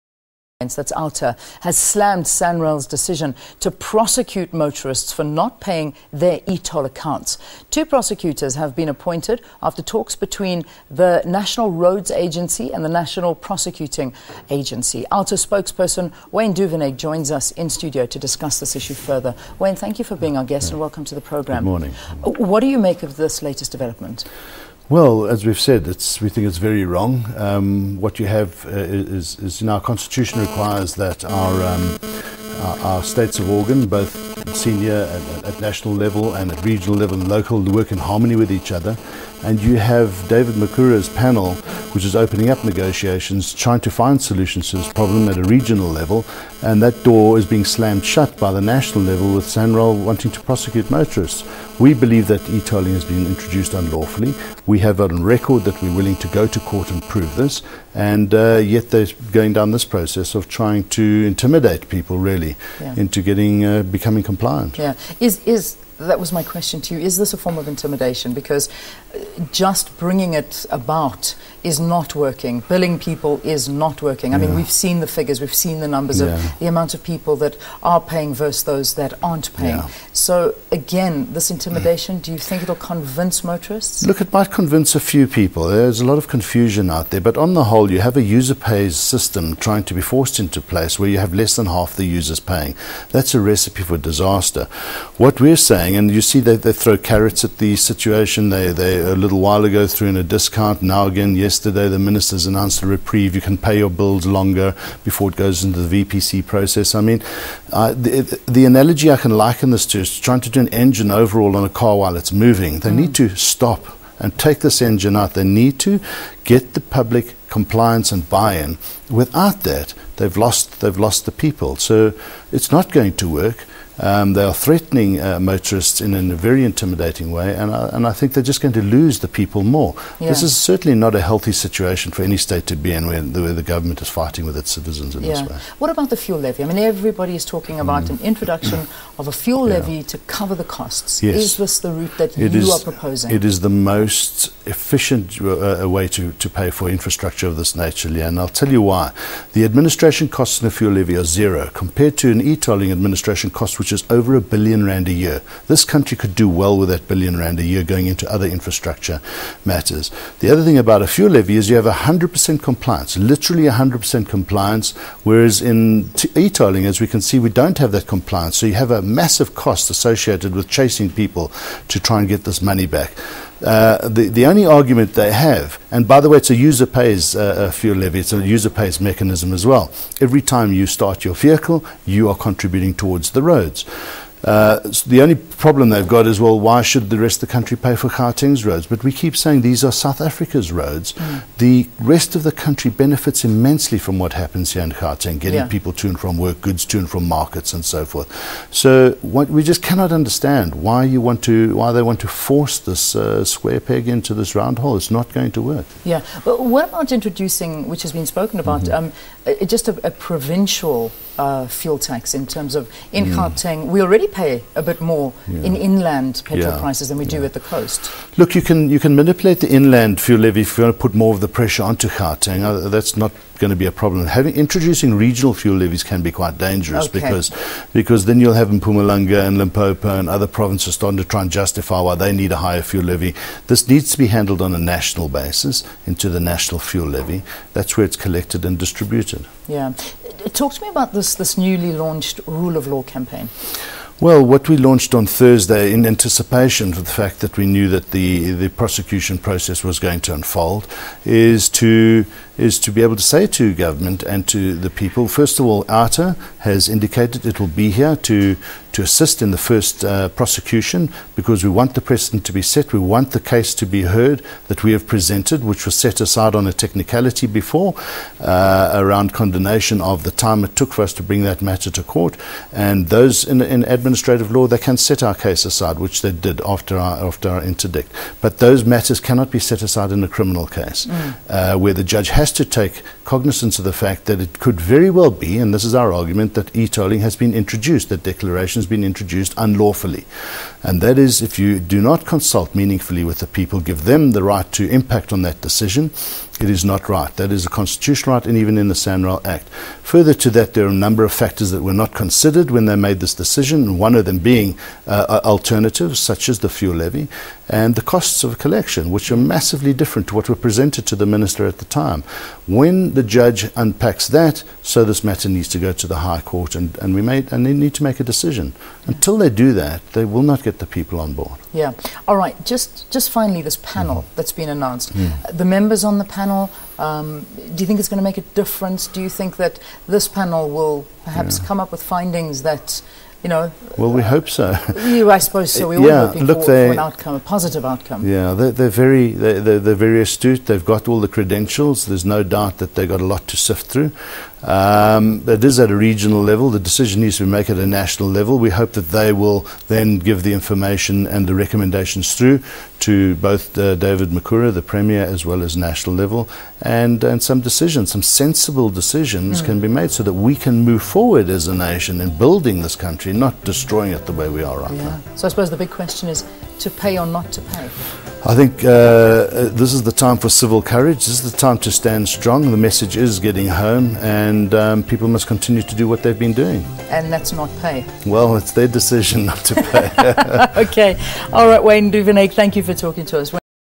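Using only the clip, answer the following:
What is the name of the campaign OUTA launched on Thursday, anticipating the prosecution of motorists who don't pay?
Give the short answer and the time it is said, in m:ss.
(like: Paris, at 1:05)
rule of law campaign, at 4:02.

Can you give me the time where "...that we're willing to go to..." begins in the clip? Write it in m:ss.
0:55.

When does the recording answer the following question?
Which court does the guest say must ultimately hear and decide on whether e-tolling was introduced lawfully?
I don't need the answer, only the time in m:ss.
5:16.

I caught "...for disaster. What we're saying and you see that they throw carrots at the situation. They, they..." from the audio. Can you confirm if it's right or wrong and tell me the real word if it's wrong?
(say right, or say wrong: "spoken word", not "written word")
right.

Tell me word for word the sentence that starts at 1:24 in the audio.
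Look, it might convince a few people.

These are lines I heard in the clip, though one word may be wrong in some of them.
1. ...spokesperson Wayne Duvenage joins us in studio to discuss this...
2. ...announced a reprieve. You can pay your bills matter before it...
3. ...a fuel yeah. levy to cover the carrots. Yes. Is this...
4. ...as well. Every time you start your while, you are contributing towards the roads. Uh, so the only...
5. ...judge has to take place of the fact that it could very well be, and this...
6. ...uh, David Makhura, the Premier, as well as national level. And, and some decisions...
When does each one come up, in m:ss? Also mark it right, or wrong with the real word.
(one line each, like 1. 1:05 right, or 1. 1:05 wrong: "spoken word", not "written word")
1. 0:15 right
2. 1:42 wrong: "longer", not "matter"
3. 2:19 wrong: "costs", not "carrots"
4. 2:59 wrong: "vehicle", not "while"
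5. 4:42 wrong: "cognizance", not "place"
6. 5:53 right.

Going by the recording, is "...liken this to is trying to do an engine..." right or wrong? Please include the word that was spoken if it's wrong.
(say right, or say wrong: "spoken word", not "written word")
right.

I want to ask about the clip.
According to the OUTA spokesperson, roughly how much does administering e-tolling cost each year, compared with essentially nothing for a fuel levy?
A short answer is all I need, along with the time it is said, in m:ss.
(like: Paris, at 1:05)
over a billion rand, at 2:34.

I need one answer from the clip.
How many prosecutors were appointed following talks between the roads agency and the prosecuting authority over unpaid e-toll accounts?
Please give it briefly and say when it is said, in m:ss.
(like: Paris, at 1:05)
2, at 0:07.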